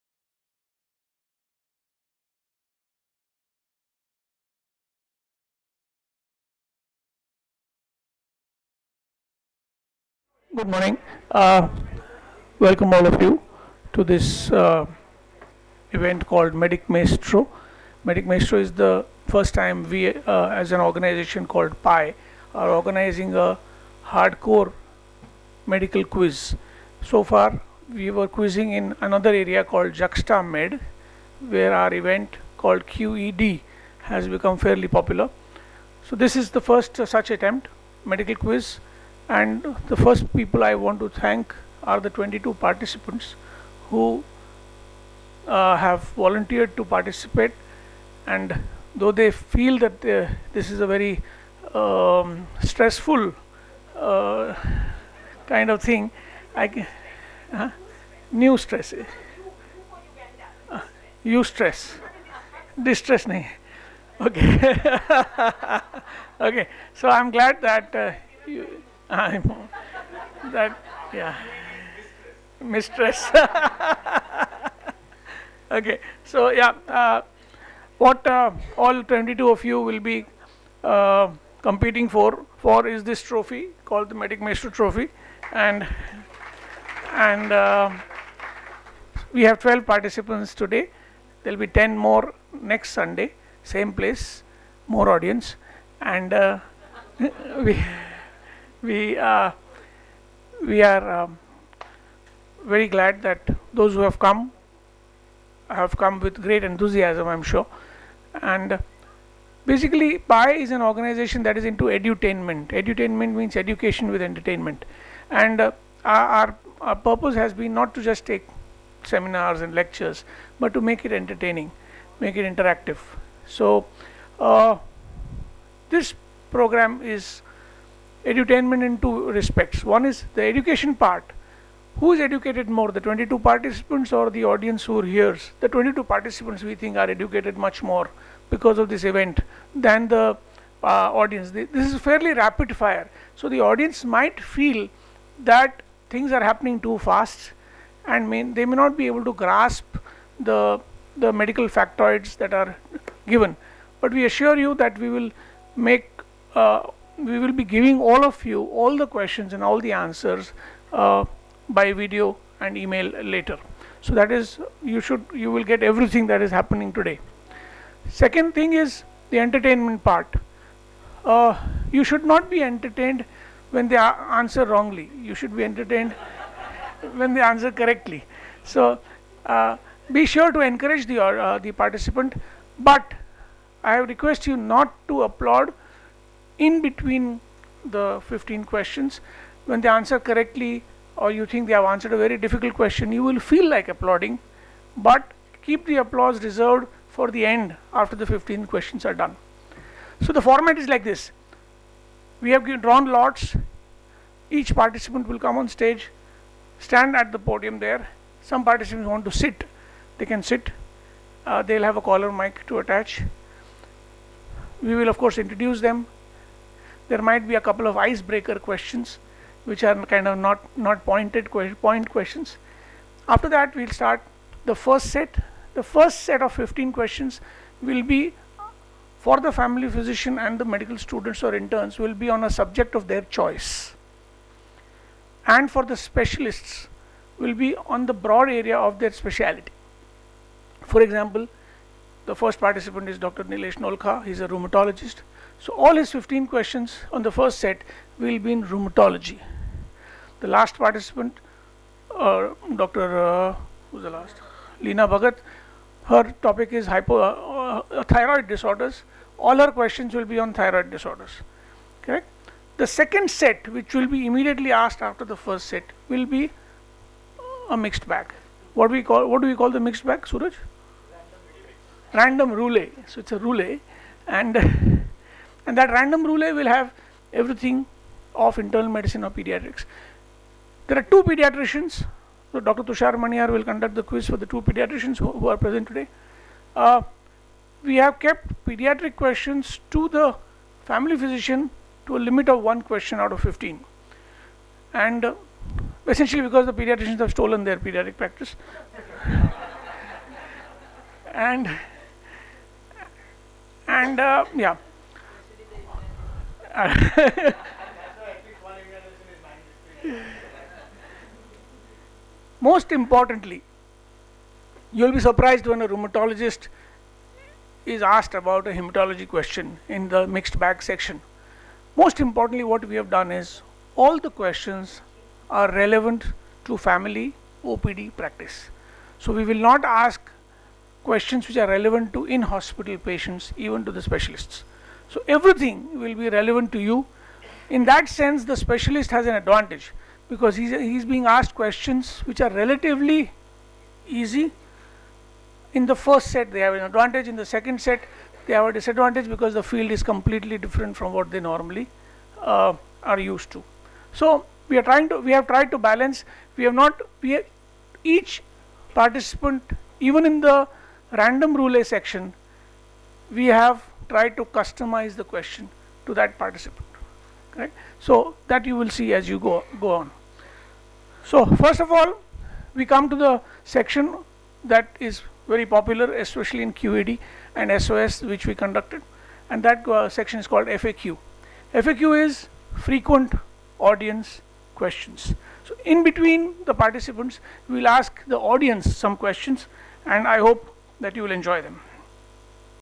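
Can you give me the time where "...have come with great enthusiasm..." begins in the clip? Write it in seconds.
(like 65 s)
105 s.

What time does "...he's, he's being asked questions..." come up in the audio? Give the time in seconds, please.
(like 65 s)
340 s.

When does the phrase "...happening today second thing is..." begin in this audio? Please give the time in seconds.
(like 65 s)
166 s.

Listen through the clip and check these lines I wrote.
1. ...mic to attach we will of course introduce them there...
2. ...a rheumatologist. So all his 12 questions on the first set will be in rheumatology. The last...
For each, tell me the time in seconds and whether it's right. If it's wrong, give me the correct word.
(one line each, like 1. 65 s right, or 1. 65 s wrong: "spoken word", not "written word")
1. 212 s right
2. 244 s wrong: "15", not "12".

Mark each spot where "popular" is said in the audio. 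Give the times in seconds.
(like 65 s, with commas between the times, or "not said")
34 s, 375 s.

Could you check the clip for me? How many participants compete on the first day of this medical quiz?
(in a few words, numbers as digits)
12.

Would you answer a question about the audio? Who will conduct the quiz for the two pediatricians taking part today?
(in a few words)
Dr. Tushar Maniar.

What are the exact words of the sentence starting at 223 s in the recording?
After that we'll start the first set.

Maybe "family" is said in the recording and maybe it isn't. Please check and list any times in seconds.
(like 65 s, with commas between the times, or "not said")
229 s, 290 s, 326 s.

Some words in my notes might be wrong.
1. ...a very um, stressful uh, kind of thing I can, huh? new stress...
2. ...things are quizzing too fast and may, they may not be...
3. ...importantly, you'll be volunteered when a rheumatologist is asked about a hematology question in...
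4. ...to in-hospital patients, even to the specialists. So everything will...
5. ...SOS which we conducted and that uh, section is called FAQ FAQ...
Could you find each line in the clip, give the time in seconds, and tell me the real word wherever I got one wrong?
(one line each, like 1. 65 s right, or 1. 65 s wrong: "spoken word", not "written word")
1. 50 s right
2. 146 s wrong: "happening", not "quizzing"
3. 312 s wrong: "surprised", not "volunteered"
4. 332 s right
5. 377 s right.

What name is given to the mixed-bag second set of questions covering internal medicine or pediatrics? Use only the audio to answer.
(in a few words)
Random roulette.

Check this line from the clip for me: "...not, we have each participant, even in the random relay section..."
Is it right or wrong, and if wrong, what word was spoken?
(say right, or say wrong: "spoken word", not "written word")
right.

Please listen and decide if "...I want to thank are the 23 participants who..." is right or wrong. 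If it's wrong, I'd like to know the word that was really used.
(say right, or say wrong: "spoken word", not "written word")
wrong: "22", not "23".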